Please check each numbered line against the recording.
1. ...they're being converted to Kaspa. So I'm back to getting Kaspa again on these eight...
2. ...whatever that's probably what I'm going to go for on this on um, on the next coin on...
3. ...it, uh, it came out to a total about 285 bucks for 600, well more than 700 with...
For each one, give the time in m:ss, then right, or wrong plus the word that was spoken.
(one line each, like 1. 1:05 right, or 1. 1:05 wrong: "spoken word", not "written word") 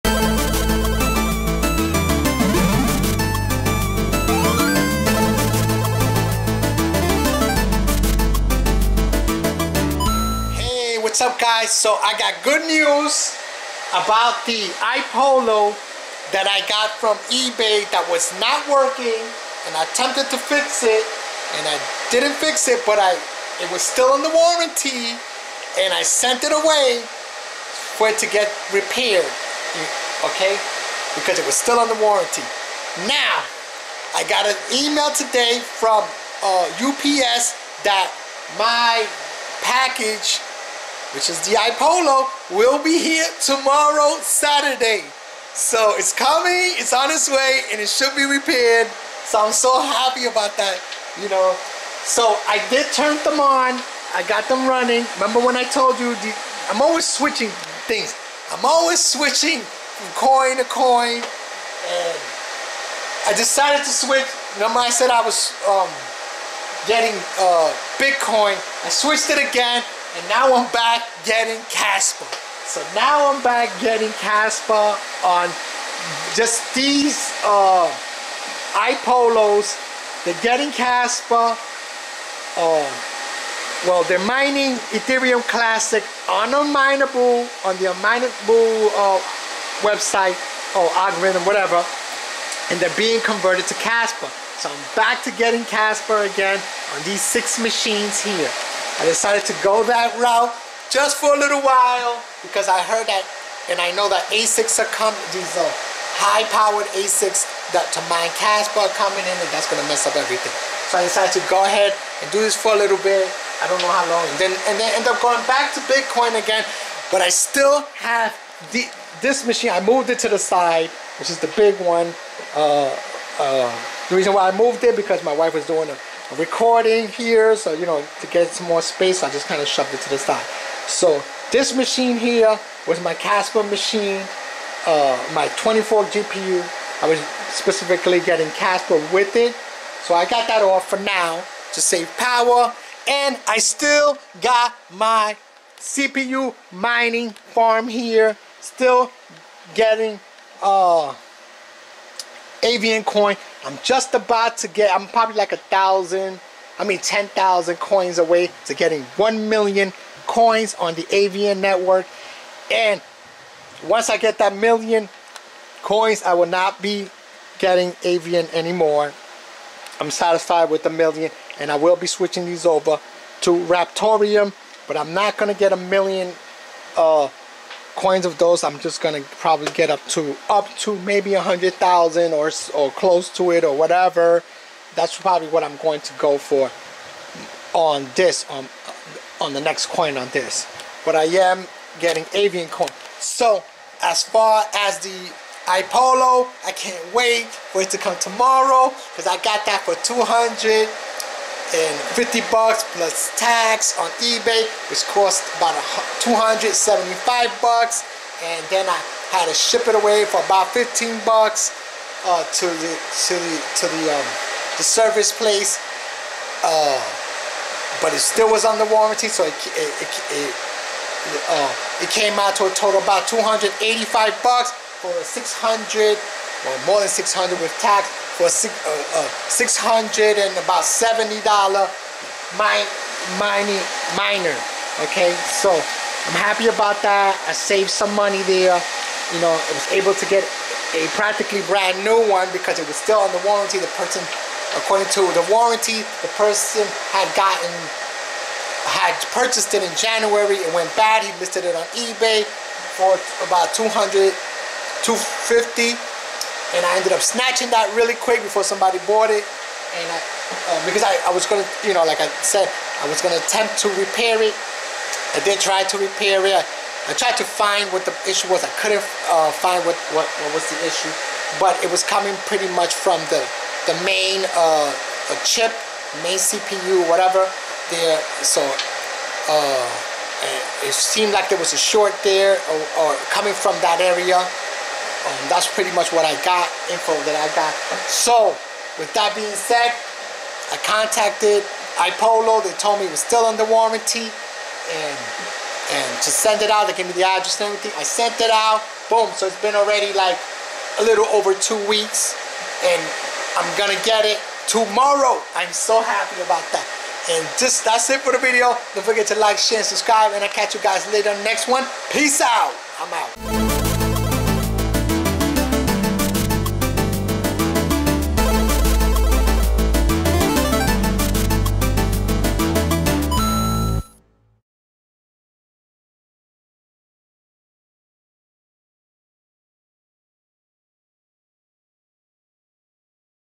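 1. 1:32 wrong: "six", not "eight"
2. 3:03 right
3. 3:40 wrong: "600", not "700".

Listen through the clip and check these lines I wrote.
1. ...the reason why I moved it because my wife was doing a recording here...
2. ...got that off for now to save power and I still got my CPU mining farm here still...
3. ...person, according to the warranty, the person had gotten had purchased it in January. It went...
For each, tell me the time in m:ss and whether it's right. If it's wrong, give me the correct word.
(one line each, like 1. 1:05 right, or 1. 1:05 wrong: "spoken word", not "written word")
1. 2:04 right
2. 2:20 right
3. 4:03 right.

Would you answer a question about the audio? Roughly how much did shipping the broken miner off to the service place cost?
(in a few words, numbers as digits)
$15.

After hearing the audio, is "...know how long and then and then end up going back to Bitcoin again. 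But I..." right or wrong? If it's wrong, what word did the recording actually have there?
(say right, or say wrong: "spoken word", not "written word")
right.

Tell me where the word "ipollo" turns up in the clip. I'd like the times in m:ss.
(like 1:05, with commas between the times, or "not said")
0:14, 0:41, 1:18, 3:15, 4:52.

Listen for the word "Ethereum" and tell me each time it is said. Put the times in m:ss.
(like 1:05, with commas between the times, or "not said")
1:24.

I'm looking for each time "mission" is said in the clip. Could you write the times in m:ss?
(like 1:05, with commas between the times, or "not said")
not said.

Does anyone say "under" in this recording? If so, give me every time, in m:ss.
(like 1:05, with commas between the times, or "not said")
3:38, 4:03, 4:53.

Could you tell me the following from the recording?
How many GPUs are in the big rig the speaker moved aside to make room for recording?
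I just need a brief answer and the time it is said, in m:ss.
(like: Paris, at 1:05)
24, at 2:15.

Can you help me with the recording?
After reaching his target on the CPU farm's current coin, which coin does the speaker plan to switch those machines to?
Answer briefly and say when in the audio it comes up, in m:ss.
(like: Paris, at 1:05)
Raptoreum, at 2:53.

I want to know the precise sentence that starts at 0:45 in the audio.
So it's coming, it's on its way, and it should be repaired.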